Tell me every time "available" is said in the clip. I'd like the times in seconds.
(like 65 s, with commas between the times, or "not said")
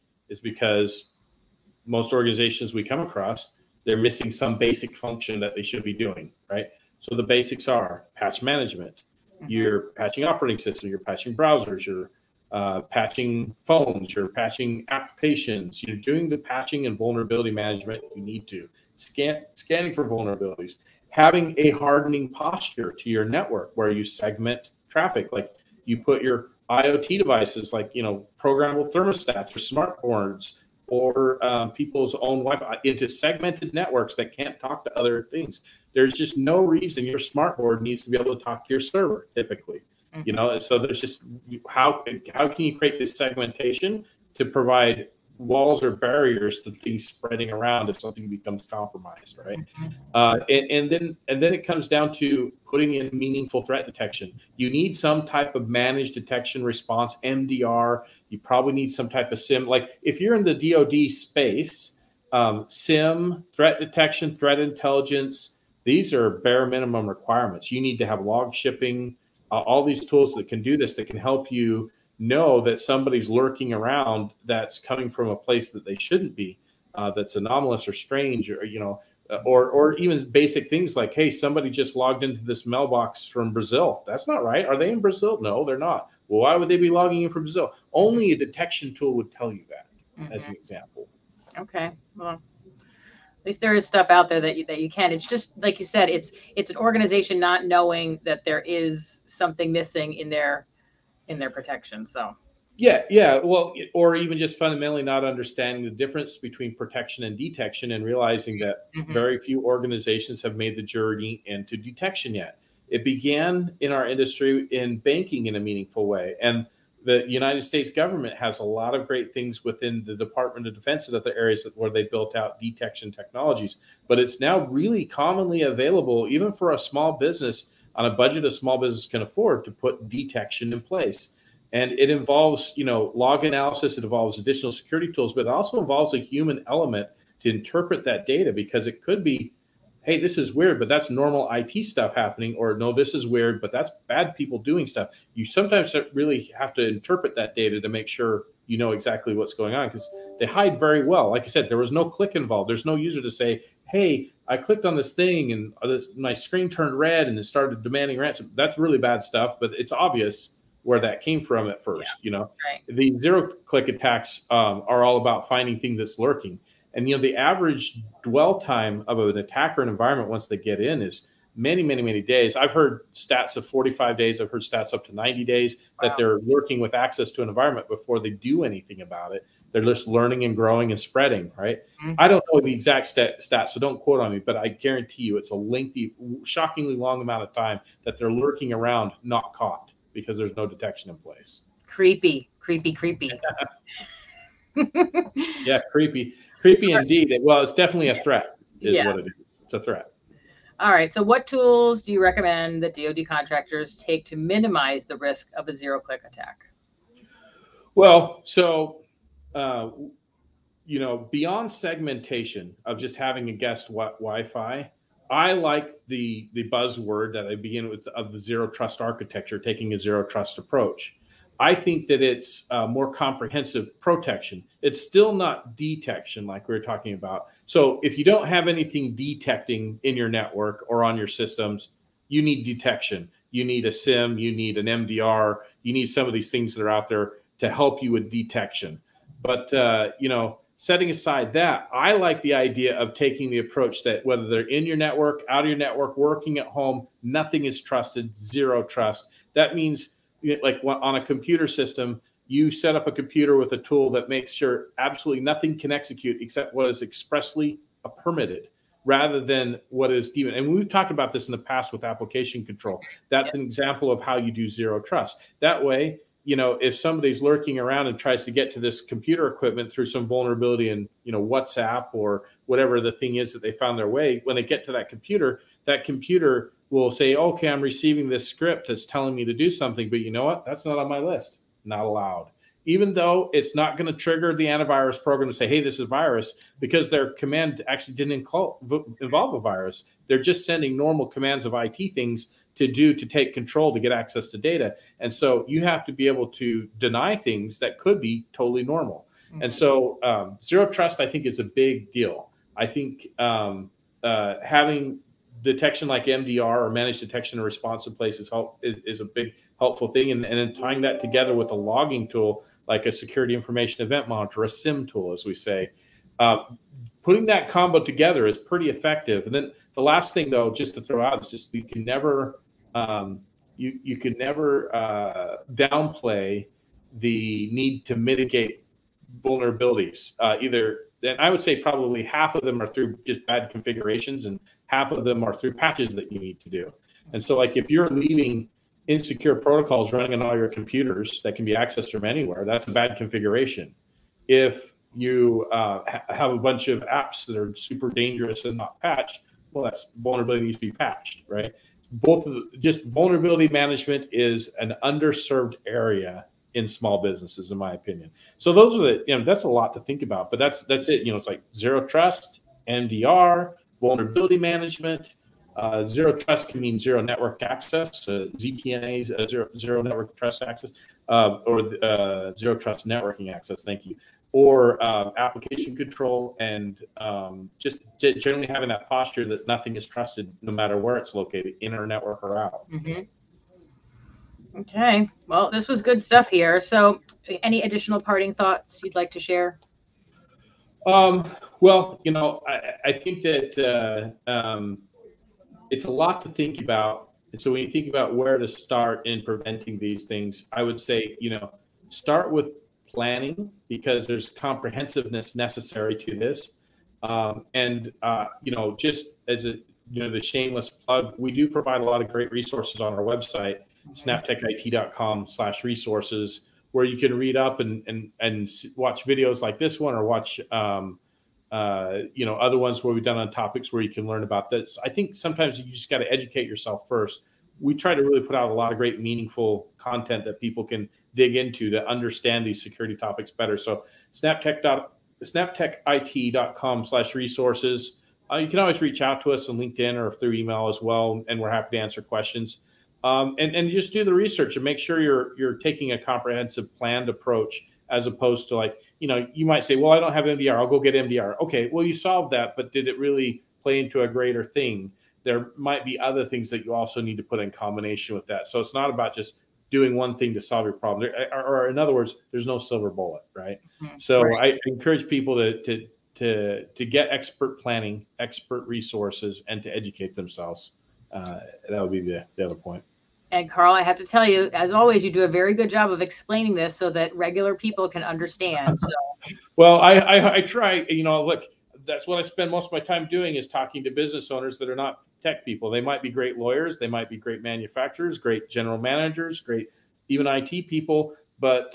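125 s.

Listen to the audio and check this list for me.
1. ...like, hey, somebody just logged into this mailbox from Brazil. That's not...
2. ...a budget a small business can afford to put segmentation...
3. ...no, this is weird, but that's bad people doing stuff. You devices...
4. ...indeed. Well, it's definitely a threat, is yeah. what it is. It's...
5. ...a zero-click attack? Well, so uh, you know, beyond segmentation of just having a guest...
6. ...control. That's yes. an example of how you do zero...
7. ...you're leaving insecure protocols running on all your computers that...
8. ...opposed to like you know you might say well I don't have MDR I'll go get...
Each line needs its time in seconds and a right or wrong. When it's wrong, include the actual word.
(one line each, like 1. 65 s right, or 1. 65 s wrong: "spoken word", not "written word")
1. 80 s right
2. 128 s wrong: "detection", not "segmentation"
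3. 142 s wrong: "sometimes", not "devices"
4. 196 s right
5. 205 s right
6. 262 s right
7. 337 s right
8. 448 s right.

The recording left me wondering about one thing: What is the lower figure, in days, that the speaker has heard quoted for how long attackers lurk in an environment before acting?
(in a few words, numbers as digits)
45 days.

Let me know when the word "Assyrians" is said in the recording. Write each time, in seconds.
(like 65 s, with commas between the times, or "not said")
not said.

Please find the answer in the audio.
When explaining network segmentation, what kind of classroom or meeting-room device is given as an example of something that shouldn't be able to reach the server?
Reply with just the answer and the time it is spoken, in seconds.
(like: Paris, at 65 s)
smart boards, at 29 s.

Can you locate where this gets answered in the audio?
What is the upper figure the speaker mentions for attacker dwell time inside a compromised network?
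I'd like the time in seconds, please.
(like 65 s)
175 s.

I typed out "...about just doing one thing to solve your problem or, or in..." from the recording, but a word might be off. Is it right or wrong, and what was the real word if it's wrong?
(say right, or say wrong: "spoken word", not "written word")
right.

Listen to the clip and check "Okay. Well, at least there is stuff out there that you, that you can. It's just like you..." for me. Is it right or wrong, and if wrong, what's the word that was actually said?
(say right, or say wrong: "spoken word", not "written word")
right.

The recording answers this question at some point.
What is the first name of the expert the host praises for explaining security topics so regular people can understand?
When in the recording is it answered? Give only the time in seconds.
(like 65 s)
473 s.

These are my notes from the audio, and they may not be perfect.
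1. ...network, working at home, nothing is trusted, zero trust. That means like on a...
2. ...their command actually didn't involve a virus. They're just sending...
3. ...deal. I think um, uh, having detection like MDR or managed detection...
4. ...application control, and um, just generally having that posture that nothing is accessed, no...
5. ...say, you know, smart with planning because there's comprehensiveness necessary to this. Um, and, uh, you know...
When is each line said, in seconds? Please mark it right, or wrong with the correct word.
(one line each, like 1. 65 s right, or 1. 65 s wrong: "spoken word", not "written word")
1. 245 s right
2. 287 s right
3. 302 s right
4. 375 s wrong: "trusted", not "accessed"
5. 400 s wrong: "start", not "smart".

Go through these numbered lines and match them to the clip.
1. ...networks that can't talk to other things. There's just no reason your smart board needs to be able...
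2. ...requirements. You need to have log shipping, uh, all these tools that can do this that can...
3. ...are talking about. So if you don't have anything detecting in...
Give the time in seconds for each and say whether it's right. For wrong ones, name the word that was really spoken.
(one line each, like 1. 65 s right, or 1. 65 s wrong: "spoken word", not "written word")
1. 33 s right
2. 67 s right
3. 226 s right.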